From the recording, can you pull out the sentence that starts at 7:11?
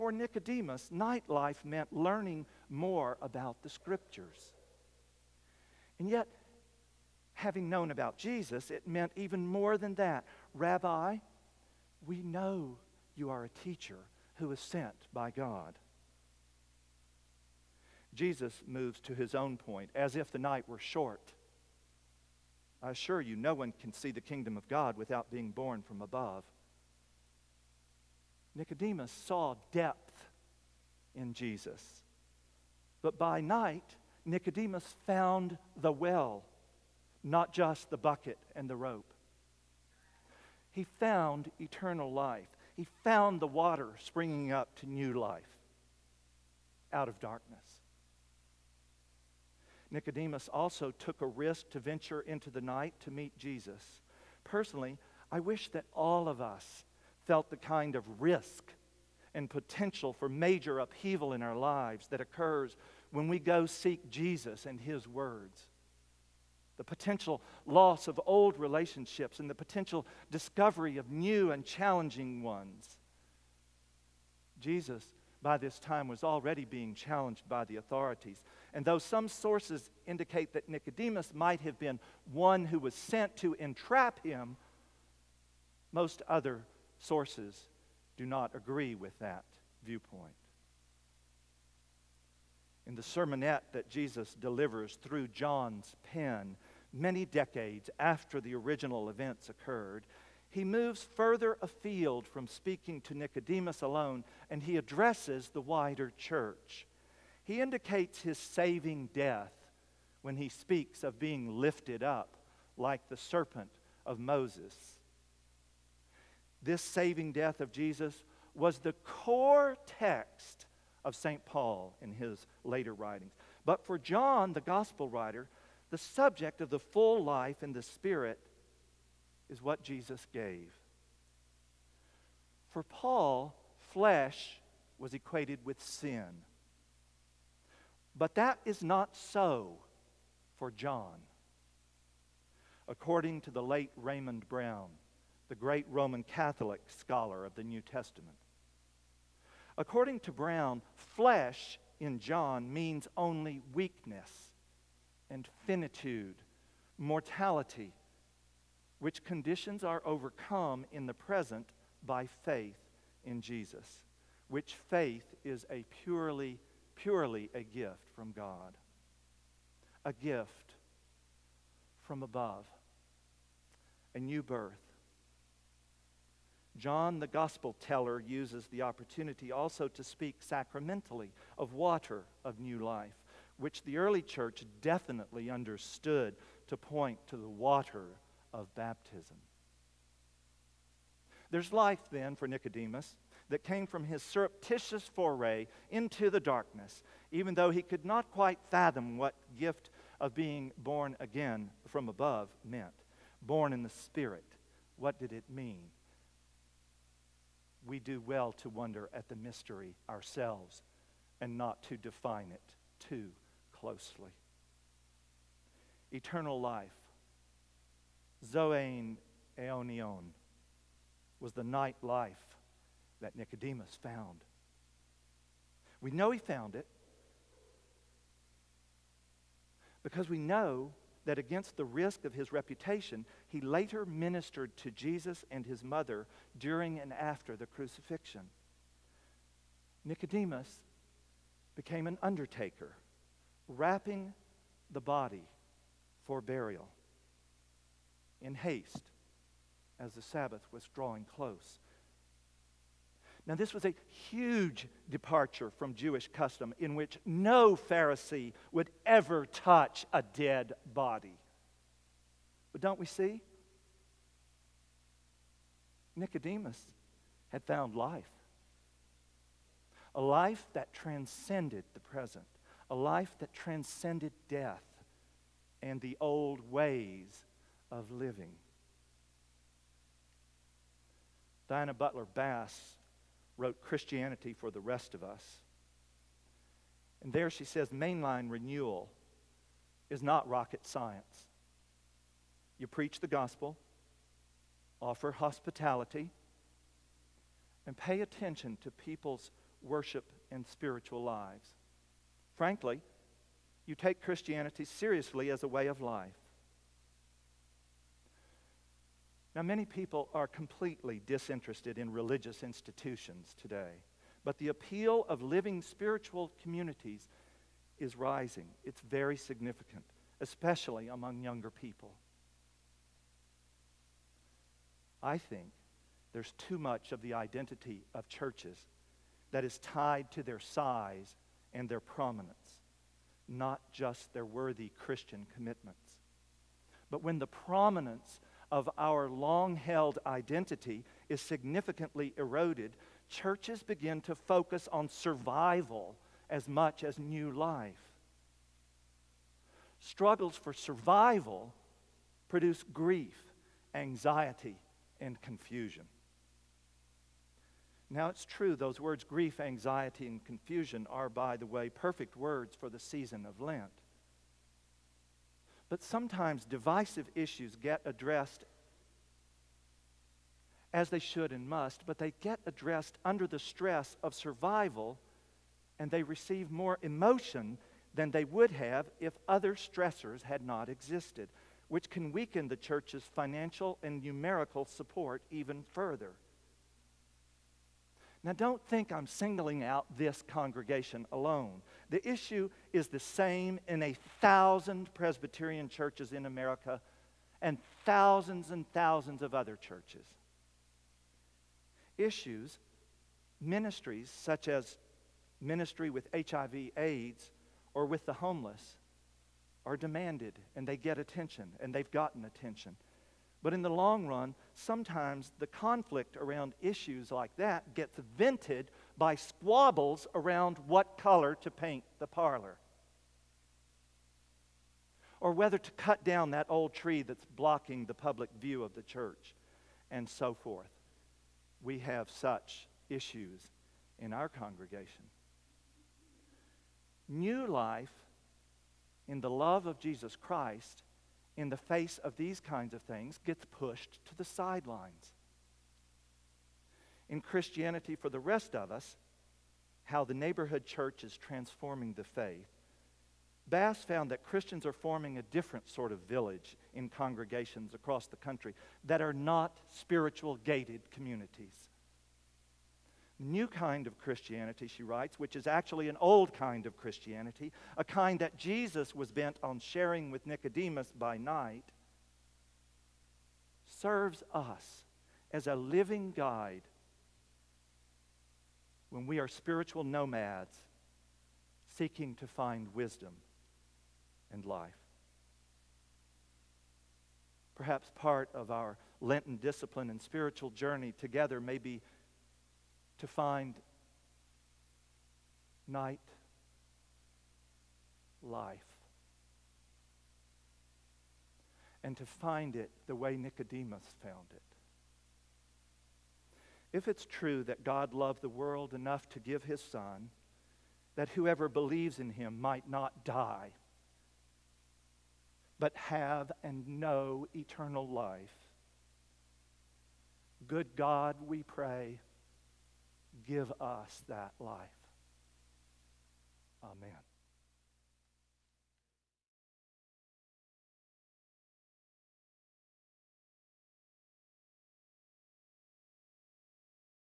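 We have such issues in our congregation.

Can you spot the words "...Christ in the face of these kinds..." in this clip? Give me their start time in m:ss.
7:20.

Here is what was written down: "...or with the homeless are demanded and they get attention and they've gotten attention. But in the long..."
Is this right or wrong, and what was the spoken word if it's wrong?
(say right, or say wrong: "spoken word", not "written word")
right.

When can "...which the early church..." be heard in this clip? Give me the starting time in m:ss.
3:03.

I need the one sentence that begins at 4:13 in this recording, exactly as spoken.
Now, this was a huge departure from Jewish custom in which no Pharisee would ever touch a dead body.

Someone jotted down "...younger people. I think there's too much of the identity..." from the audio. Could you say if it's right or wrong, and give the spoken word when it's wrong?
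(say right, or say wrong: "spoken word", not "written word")
right.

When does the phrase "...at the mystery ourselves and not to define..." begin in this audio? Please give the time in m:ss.
3:29.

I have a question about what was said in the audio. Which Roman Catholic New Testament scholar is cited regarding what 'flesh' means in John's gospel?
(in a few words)
Raymond Brown.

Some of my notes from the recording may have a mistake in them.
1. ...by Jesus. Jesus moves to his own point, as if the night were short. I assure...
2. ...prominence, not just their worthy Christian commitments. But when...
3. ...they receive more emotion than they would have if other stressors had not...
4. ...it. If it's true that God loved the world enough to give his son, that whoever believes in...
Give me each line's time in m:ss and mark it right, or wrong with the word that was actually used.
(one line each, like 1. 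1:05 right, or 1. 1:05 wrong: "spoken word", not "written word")
1. 0:15 wrong: "God", not "Jesus"
2. 5:31 right
3. 6:16 right
4. 8:24 right.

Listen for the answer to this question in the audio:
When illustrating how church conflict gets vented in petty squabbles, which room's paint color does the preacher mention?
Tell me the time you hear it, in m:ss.
7:02.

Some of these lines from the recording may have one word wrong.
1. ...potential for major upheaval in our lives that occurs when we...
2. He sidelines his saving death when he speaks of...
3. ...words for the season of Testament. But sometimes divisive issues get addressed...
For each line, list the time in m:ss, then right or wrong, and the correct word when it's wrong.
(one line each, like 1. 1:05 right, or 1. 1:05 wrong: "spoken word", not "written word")
1. 0:59 right
2. 1:47 wrong: "indicates", not "sidelines"
3. 6:02 wrong: "Lent", not "Testament".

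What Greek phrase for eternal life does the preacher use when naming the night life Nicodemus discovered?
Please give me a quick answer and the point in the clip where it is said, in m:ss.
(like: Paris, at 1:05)
Zoein Eonion, at 3:38.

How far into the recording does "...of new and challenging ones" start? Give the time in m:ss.
1:10.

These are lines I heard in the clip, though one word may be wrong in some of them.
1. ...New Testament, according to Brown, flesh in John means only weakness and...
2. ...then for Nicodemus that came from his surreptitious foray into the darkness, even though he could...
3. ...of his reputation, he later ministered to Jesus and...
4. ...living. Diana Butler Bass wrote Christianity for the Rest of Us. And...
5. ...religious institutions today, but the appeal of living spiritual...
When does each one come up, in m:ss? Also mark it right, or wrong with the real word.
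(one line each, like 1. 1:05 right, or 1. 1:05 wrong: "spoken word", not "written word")
1. 2:27 right
2. 3:12 right
3. 3:52 right
4. 4:38 right
5. 5:12 right.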